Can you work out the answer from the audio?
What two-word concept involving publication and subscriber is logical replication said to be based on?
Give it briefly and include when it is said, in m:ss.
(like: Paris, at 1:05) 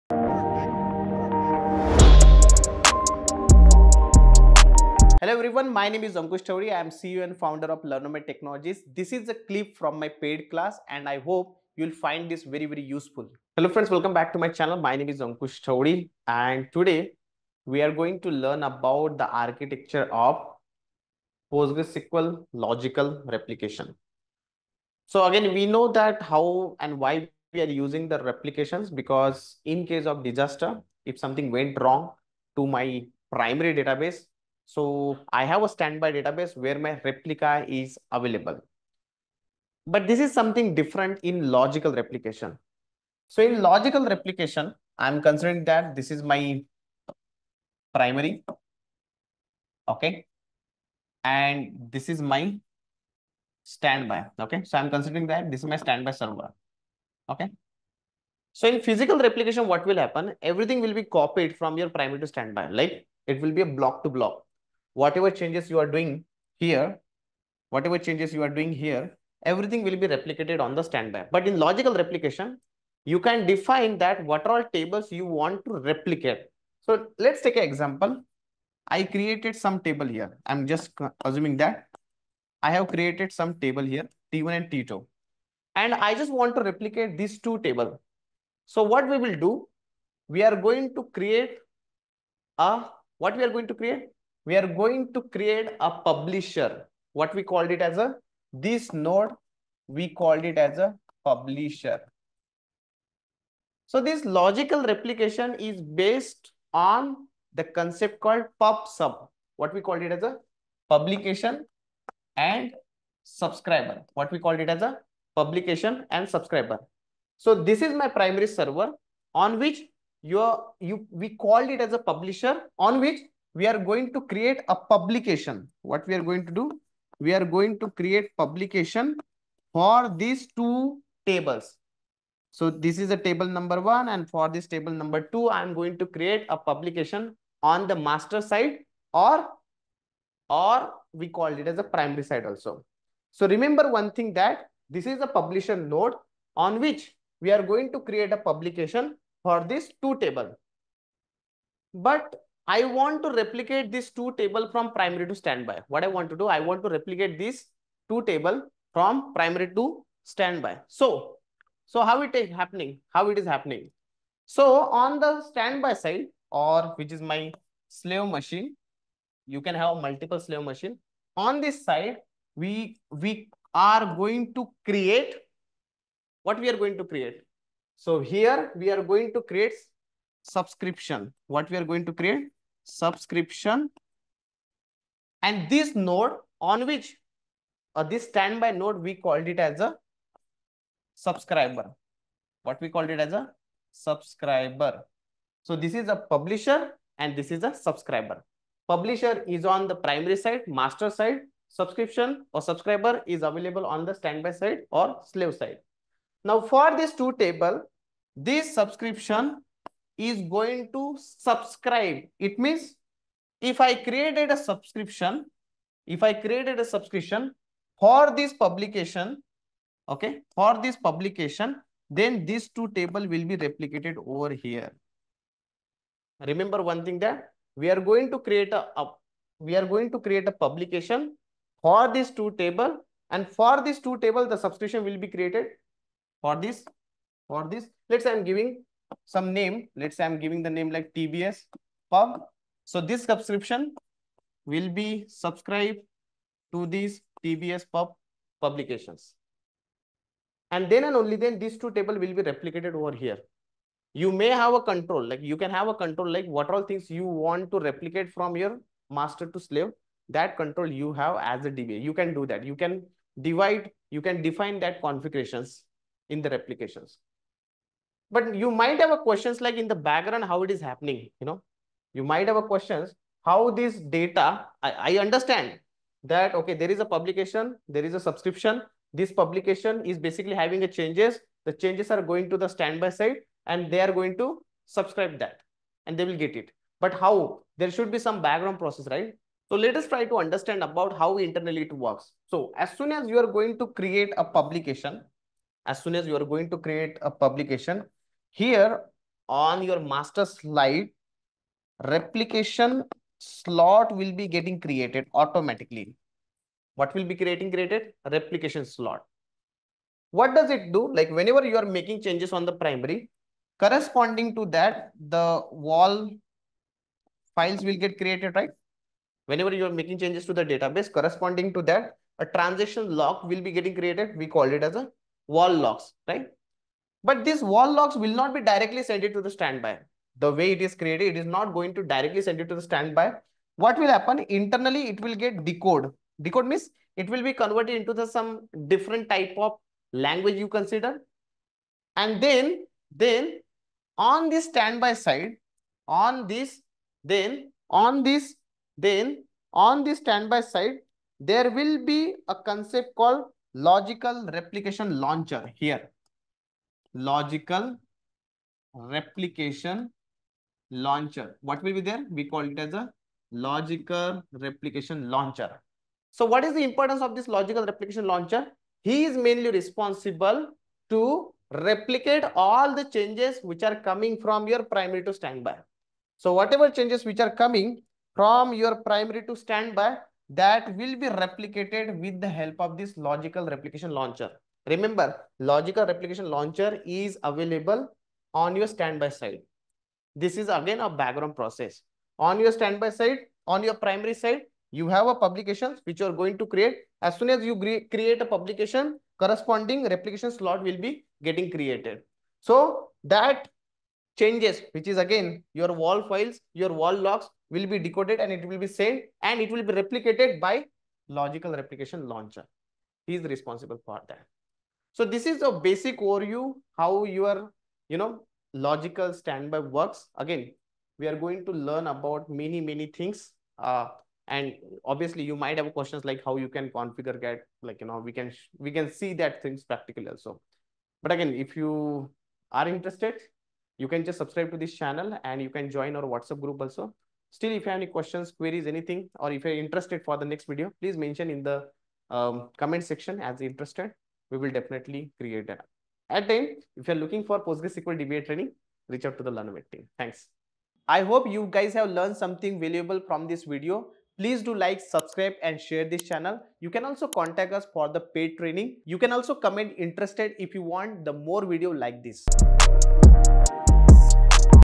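pub sub, at 1:48.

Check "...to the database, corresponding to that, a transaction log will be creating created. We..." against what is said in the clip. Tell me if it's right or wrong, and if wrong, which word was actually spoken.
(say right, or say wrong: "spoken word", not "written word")
wrong: "getting", not "creating".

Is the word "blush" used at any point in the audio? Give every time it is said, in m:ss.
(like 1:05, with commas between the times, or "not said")
not said.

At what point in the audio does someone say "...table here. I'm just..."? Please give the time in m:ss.
1:19.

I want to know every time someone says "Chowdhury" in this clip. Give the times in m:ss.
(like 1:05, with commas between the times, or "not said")
0:06, 0:15.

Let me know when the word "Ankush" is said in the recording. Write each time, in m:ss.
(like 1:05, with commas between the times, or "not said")
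0:06, 0:15.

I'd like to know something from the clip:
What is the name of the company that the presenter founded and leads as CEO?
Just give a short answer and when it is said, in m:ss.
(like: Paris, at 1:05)
Learnomate Technologies, at 0:07.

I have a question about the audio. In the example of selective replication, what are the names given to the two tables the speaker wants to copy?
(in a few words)
T1 and T2.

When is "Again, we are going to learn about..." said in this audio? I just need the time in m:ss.
7:00.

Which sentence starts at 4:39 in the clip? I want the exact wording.
This publication is basically having a changes.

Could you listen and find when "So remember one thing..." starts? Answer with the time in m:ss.
2:23.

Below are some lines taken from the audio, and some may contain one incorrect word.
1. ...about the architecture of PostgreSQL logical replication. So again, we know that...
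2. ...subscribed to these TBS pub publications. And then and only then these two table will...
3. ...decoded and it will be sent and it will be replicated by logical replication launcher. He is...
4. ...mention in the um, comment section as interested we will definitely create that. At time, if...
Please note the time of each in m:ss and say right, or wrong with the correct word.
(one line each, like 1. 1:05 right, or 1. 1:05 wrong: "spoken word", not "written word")
1. 0:18 right
2. 4:05 right
3. 6:47 right
4. 7:21 right.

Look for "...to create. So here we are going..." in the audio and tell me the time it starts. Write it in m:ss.
2:56.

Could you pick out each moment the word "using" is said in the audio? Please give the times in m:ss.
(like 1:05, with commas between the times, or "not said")
0:27.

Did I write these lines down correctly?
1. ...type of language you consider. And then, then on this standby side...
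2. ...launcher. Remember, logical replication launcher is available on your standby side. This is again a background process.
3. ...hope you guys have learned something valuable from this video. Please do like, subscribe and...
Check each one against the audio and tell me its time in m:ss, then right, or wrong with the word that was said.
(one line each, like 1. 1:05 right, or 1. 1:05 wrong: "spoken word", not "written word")
1. 5:39 right
2. 6:24 right
3. 7:31 right.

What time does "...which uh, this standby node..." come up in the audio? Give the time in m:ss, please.
3:06.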